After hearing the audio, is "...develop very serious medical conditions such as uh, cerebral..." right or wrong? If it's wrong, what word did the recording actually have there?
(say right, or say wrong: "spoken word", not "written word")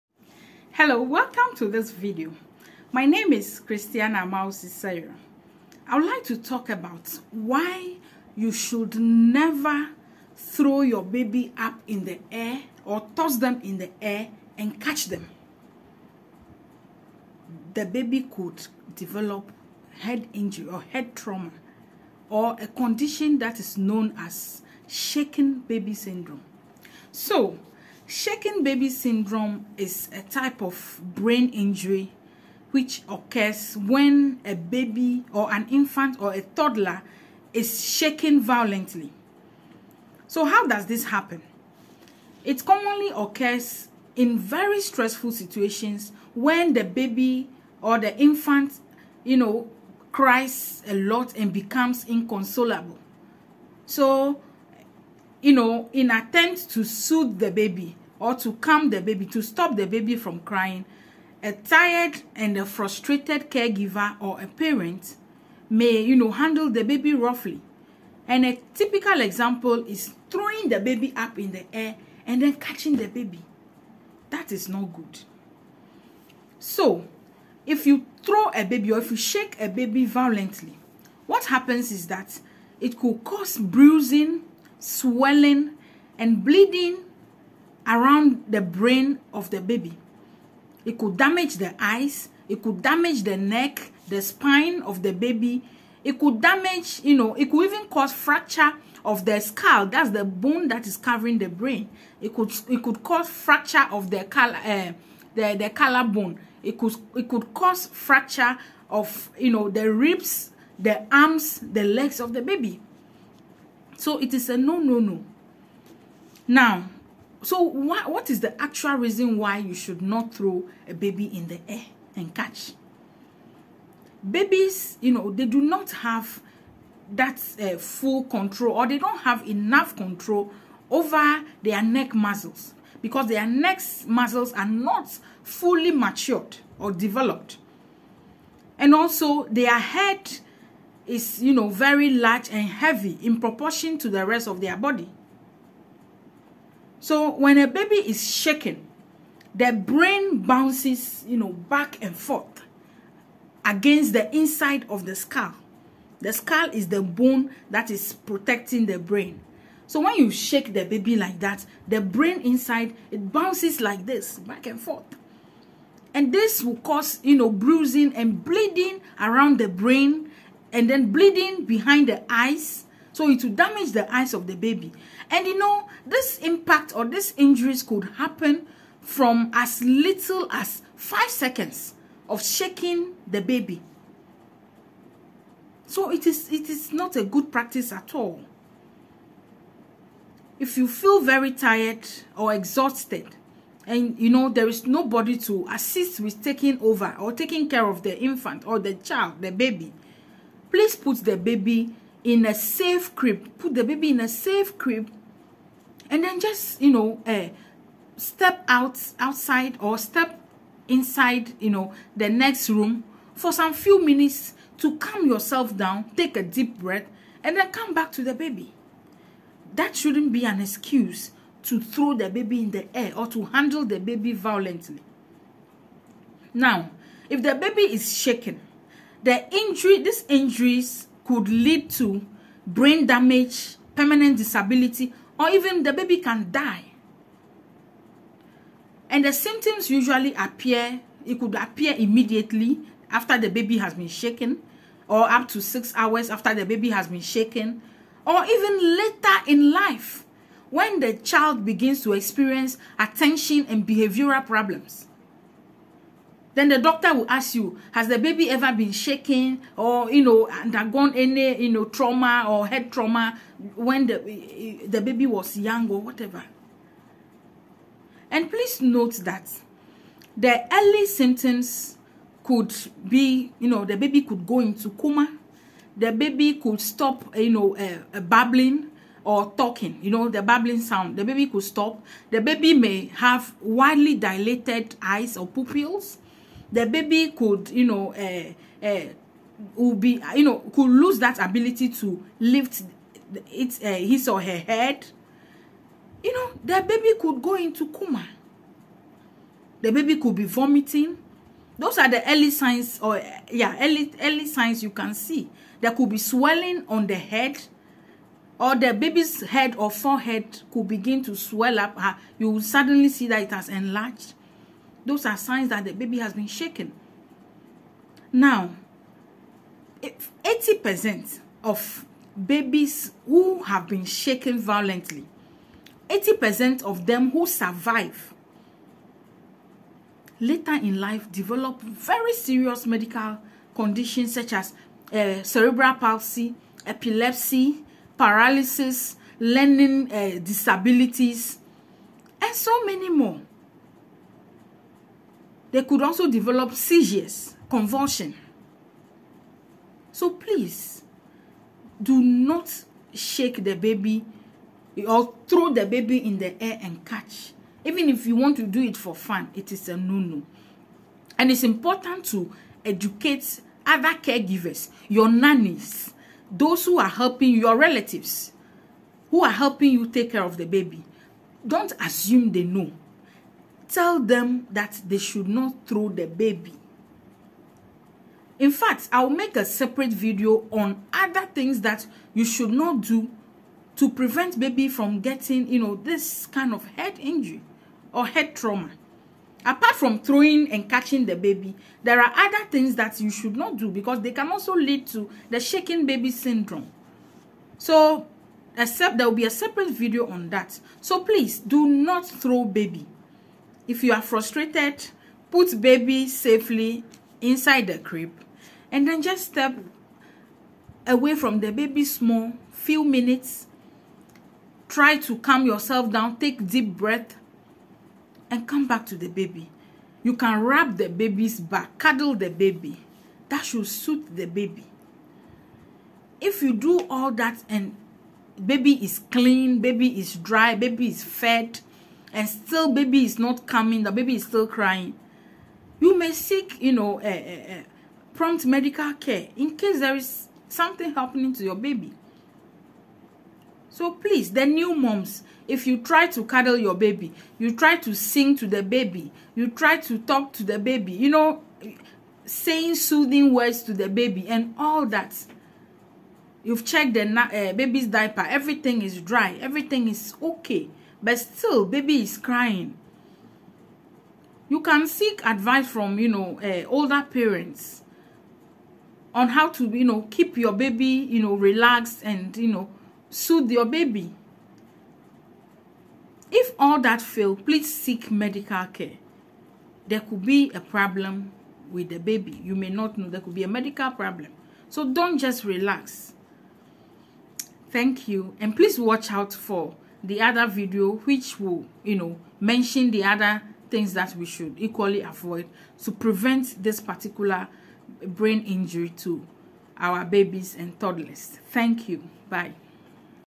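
right.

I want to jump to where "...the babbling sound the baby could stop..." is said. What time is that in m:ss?
4:40.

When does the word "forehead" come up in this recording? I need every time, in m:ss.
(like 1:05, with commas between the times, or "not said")
5:09.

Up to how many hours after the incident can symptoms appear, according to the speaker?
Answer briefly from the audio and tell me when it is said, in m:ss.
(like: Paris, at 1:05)
6 hours, at 4:05.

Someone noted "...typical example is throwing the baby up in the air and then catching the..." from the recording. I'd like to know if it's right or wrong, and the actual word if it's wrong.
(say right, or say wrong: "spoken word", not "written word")
right.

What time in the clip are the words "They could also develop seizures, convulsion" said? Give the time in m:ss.
5:45.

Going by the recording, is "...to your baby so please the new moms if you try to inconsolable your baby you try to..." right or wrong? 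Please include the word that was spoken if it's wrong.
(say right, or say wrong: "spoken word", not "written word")
wrong: "cuddle", not "inconsolable".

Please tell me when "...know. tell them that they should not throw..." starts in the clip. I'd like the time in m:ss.
6:12.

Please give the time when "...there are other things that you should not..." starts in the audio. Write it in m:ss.
6:32.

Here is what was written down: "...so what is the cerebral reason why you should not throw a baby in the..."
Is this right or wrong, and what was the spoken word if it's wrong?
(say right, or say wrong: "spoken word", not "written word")
wrong: "actual", not "cerebral".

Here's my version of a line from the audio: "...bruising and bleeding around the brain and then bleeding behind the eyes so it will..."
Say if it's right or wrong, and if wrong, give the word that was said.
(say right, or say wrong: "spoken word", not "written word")
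right.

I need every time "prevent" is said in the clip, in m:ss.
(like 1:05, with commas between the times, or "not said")
6:24, 8:16.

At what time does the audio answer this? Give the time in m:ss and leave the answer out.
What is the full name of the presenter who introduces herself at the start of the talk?
0:03.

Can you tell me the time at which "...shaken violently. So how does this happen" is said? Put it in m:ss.
0:37.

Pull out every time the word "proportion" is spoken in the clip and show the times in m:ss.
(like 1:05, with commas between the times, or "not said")
2:23.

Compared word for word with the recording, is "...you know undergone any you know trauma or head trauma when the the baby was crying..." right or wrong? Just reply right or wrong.
wrong.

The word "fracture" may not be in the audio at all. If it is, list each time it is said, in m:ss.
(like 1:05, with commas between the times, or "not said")
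1:38, 1:43, 1:47.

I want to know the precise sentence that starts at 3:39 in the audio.
That shouldn't be an excuse to throw the baby in the air or to handle the baby violently.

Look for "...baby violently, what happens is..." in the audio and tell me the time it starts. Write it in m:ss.
1:19.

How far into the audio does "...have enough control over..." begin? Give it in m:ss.
2:09.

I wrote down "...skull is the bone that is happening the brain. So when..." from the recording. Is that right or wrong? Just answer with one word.
wrong.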